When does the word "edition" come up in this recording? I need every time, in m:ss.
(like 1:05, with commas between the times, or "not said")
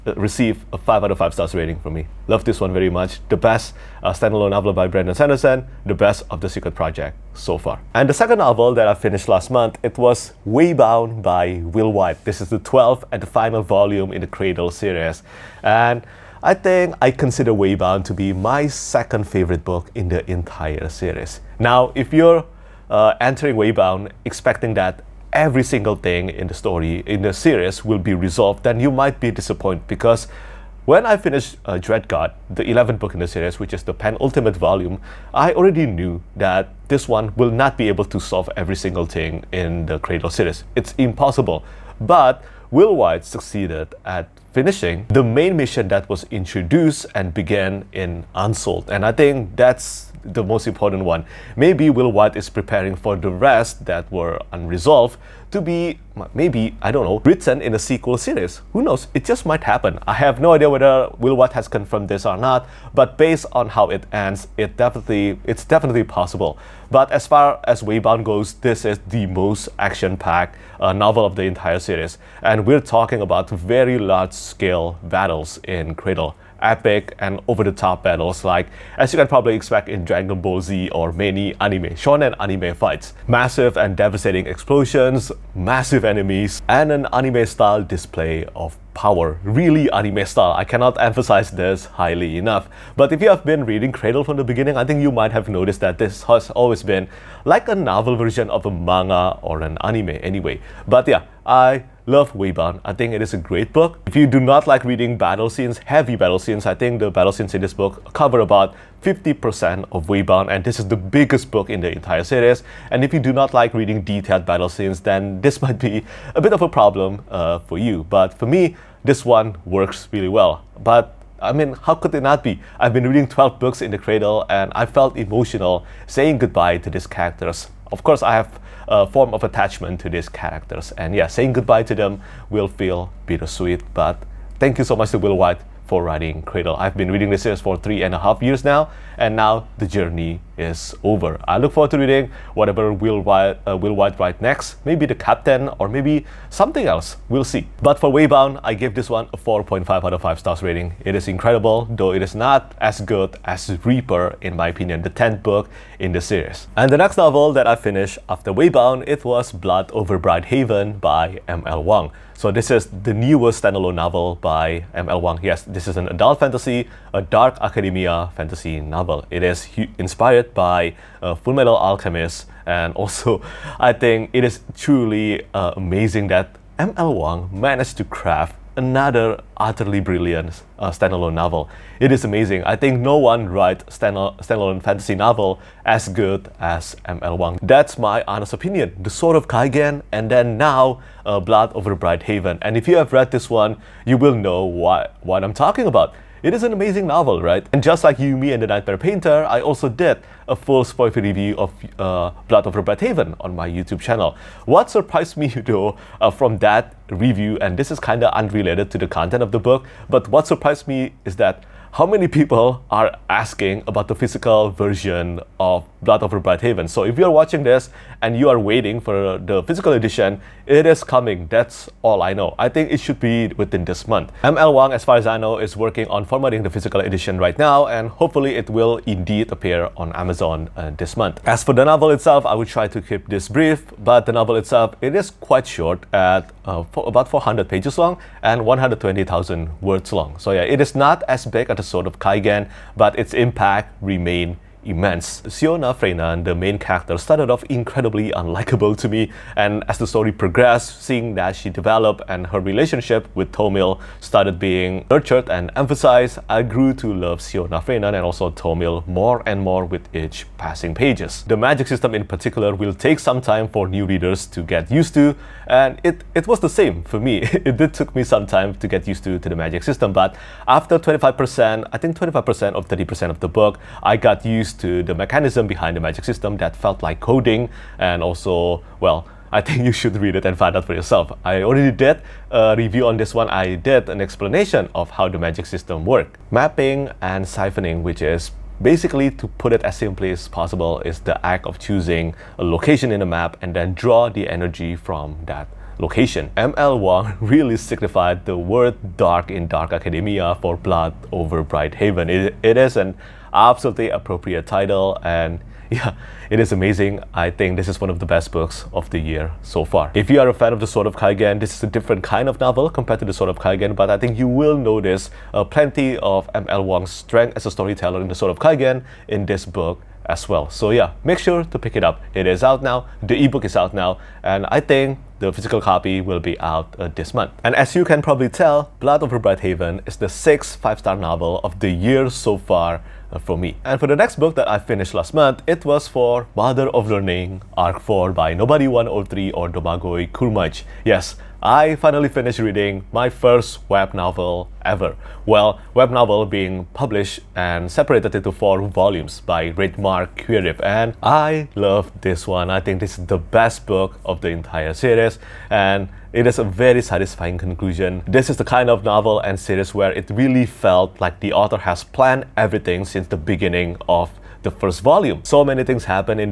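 3:39, 3:46.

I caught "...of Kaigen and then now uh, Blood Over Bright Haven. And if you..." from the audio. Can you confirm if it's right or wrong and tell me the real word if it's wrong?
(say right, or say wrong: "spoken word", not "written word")
right.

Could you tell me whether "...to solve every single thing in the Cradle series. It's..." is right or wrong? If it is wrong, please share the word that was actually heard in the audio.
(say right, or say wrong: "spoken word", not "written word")
right.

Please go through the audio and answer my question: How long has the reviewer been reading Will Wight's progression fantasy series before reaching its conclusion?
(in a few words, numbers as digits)
three and a half years.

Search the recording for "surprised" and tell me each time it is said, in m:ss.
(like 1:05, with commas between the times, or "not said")
3:24, 3:30.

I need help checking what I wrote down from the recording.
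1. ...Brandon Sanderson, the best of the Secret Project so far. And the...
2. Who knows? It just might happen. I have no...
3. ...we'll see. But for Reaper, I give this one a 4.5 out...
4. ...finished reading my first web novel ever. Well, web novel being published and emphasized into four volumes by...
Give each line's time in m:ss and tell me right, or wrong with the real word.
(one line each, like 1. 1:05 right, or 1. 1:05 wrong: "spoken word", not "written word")
1. 0:04 right
2. 0:58 right
3. 2:27 wrong: "Waybound", not "Reaper"
4. 5:42 wrong: "separated", not "emphasized".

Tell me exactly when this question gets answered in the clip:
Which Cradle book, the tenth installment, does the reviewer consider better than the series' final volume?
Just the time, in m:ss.
2:33.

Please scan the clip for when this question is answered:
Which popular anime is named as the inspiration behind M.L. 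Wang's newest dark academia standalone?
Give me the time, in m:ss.
2:51.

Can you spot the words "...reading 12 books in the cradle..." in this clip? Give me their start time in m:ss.
2:03.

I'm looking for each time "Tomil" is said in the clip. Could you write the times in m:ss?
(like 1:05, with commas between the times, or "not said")
4:13, 4:18.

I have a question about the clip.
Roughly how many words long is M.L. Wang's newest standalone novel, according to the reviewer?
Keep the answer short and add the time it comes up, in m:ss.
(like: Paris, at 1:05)
120,000, at 3:58.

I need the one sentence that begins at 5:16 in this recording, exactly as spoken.
Wang's strength as a storyteller in the Sword of Kaigen in this book as well.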